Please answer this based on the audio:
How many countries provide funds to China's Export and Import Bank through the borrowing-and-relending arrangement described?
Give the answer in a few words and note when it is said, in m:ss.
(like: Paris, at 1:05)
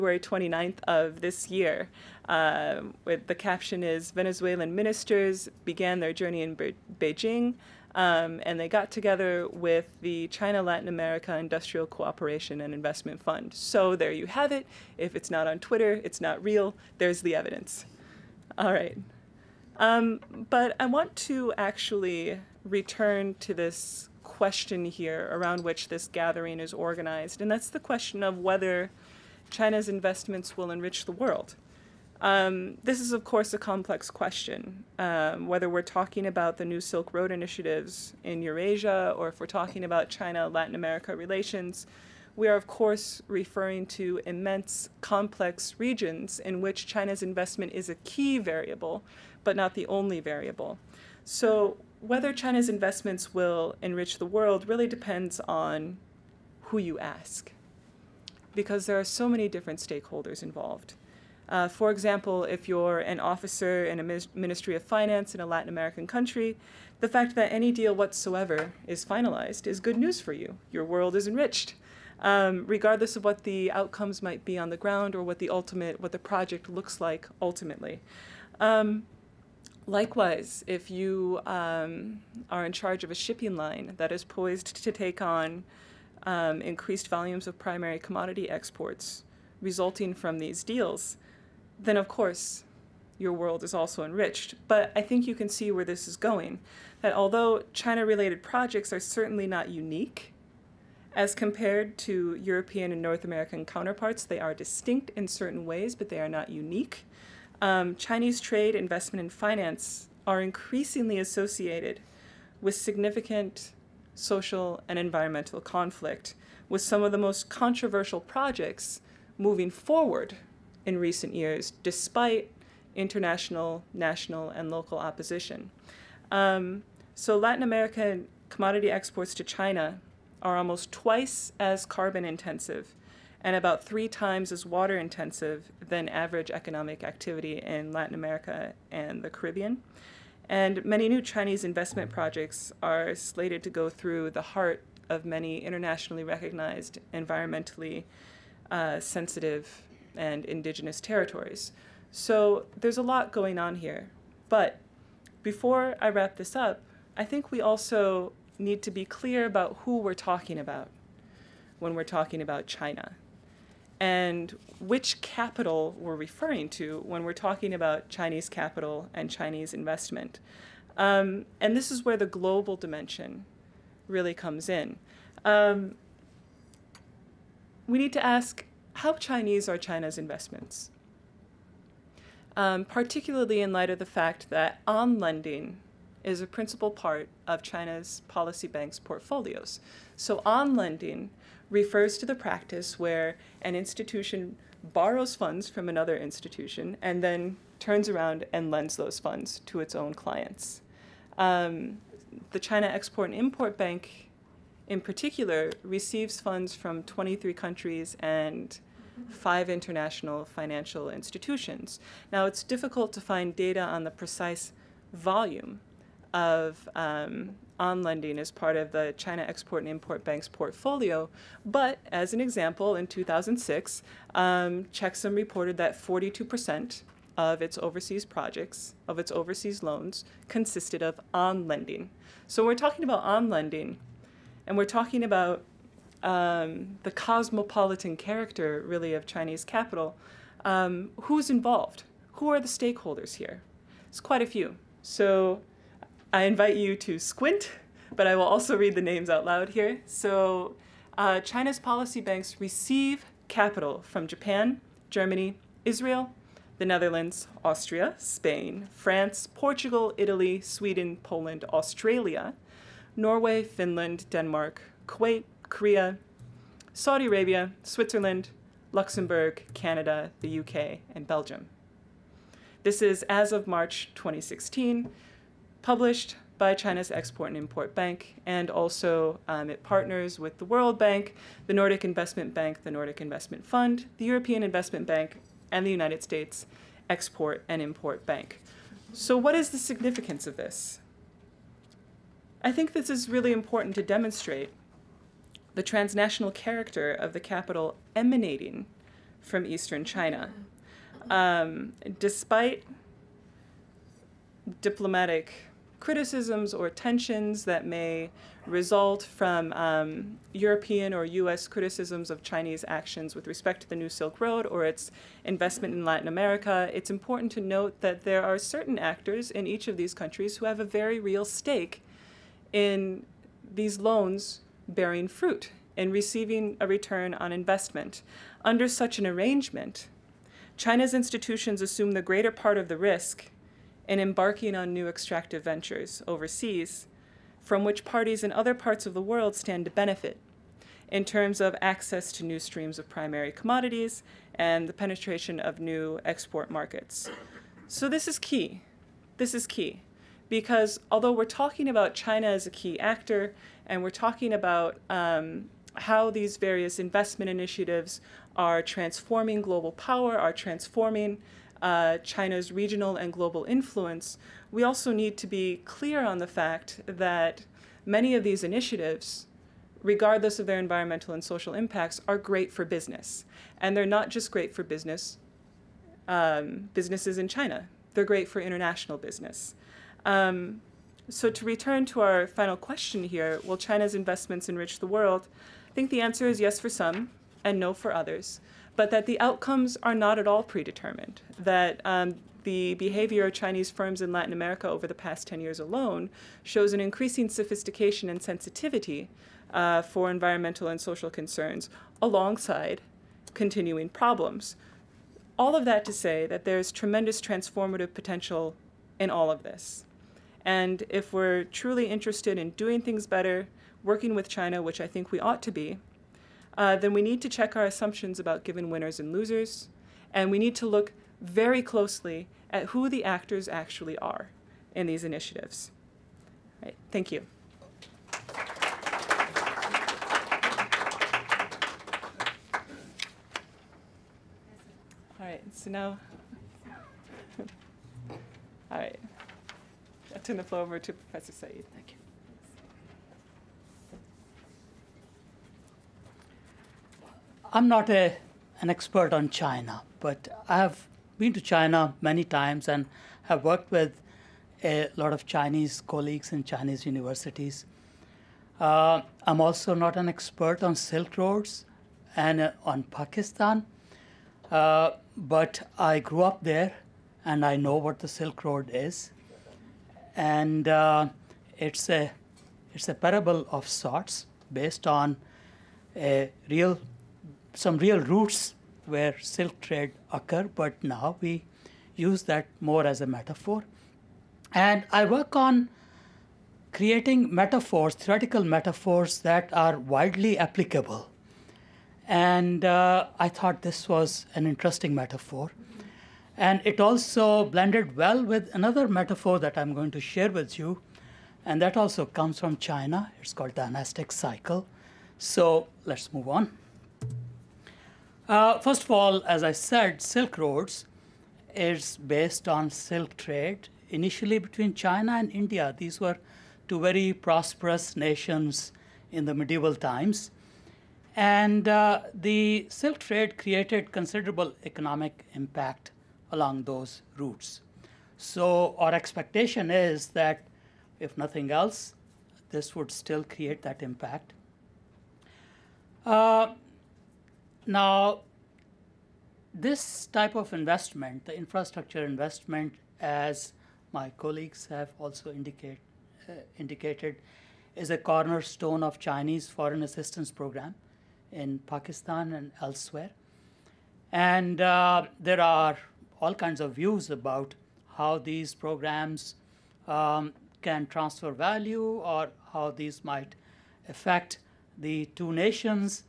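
23, at 3:27.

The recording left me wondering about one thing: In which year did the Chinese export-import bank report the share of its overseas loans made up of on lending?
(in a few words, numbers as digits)
2006.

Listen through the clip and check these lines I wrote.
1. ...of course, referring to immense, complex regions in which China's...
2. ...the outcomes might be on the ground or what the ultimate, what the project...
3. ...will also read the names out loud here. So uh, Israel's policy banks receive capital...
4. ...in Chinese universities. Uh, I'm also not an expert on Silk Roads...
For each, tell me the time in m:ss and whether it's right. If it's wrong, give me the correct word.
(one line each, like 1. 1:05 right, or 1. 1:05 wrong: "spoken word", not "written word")
1. 0:42 right
2. 1:13 right
3. 4:08 wrong: "China", not "Israel"
4. 7:36 right.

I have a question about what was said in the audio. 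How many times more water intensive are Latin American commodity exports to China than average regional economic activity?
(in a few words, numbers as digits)
3 times.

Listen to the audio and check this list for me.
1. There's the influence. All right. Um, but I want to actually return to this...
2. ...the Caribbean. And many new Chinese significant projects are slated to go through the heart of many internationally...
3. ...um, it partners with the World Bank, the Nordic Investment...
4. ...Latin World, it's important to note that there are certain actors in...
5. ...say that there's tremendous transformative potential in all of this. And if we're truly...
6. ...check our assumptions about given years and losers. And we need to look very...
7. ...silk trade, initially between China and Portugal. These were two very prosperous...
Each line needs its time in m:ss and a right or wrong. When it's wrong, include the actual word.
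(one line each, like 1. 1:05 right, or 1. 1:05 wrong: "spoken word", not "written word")
1. 0:16 wrong: "evidence", not "influence"
2. 2:19 wrong: "investment", not "significant"
3. 4:39 right
4. 5:16 wrong: "America", not "World"
5. 6:46 right
6. 6:57 wrong: "winners", not "years"
7. 8:32 wrong: "India", not "Portugal".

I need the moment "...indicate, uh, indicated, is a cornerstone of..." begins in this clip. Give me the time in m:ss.
9:05.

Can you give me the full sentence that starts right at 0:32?
Um, this is, of course, a complex question.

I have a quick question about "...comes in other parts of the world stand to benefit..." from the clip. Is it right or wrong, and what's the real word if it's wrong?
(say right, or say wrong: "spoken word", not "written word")
wrong: "parties", not "comes".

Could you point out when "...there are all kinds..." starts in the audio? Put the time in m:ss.
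9:15.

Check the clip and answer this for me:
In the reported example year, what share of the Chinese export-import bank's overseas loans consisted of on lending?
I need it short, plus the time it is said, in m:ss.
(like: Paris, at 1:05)
42%, at 3:45.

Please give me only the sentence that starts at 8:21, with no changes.
And that also comes from China.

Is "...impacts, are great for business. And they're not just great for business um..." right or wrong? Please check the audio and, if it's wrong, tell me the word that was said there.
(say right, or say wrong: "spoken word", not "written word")
right.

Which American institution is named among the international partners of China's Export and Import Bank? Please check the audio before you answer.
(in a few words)
United States Export and Import Bank.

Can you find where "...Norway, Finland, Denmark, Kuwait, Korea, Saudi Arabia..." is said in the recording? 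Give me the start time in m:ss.
4:23.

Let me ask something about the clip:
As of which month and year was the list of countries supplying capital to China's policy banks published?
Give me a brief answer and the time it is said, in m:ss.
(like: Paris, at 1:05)
March 2016, at 4:33.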